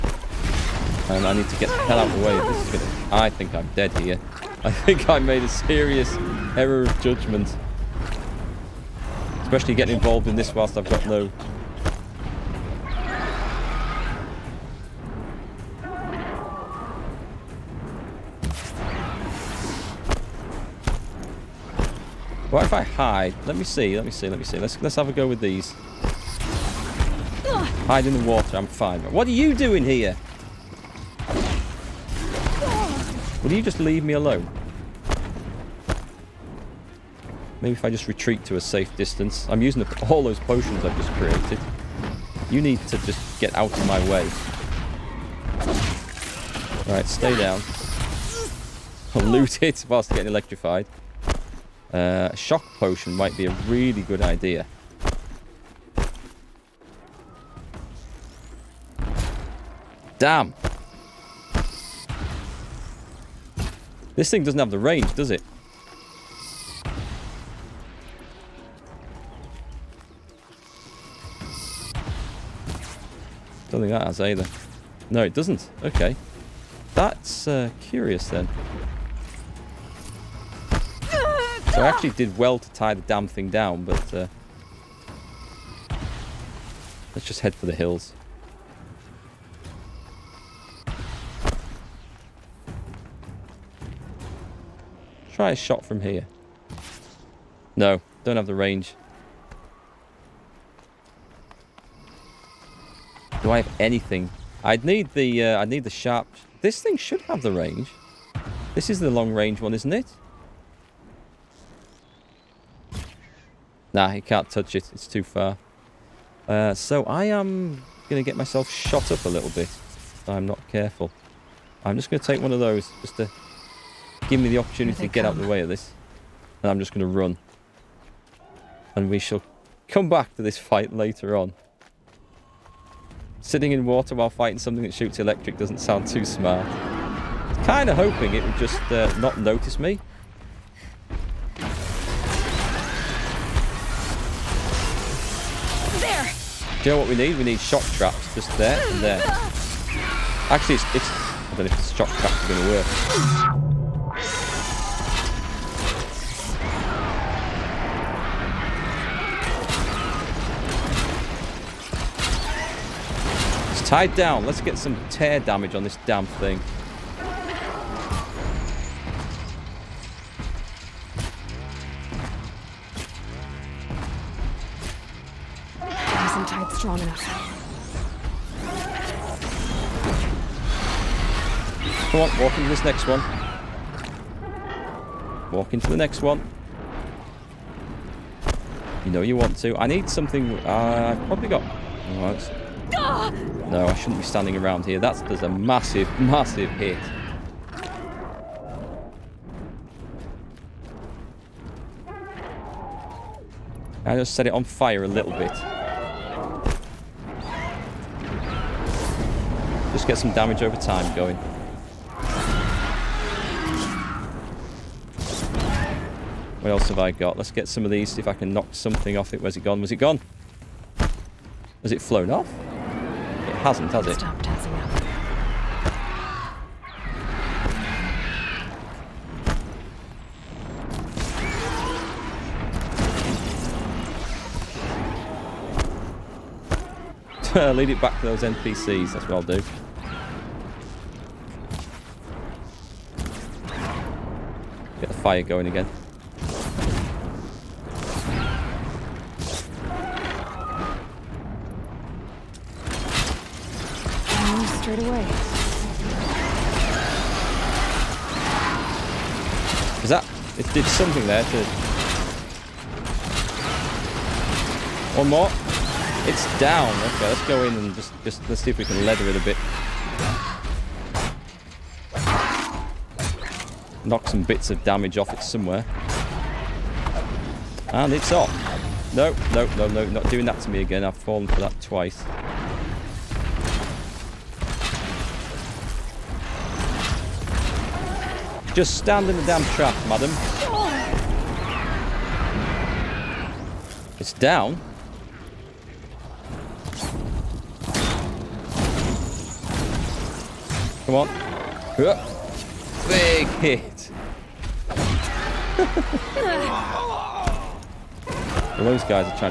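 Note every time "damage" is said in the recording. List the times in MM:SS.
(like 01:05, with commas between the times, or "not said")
02:45, 03:30, 04:34.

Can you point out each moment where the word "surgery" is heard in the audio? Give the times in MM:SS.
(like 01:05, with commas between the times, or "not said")
not said.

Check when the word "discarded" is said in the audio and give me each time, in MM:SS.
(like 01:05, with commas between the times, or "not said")
not said.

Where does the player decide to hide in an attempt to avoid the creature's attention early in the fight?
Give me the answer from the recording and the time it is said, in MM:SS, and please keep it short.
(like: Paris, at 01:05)
In the water, at 00:27.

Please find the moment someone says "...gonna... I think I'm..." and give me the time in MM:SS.
00:02.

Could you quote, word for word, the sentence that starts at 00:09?
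Especially getting involved in this whilst I've got no...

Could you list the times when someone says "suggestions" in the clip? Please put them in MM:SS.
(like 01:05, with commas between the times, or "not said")
not said.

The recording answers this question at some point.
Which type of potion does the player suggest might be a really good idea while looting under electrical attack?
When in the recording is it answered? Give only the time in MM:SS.
00:52.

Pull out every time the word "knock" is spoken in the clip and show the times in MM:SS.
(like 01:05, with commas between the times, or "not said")
03:38, 04:34.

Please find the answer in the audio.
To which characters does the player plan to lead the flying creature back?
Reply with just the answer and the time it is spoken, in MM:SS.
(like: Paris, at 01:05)
NPCs, at 03:58.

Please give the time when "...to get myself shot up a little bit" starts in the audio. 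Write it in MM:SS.
01:58.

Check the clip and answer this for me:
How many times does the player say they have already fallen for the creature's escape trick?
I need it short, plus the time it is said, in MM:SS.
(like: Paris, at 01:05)
2, at 04:41.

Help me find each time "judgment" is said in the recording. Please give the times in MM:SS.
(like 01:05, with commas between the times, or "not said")
00:07.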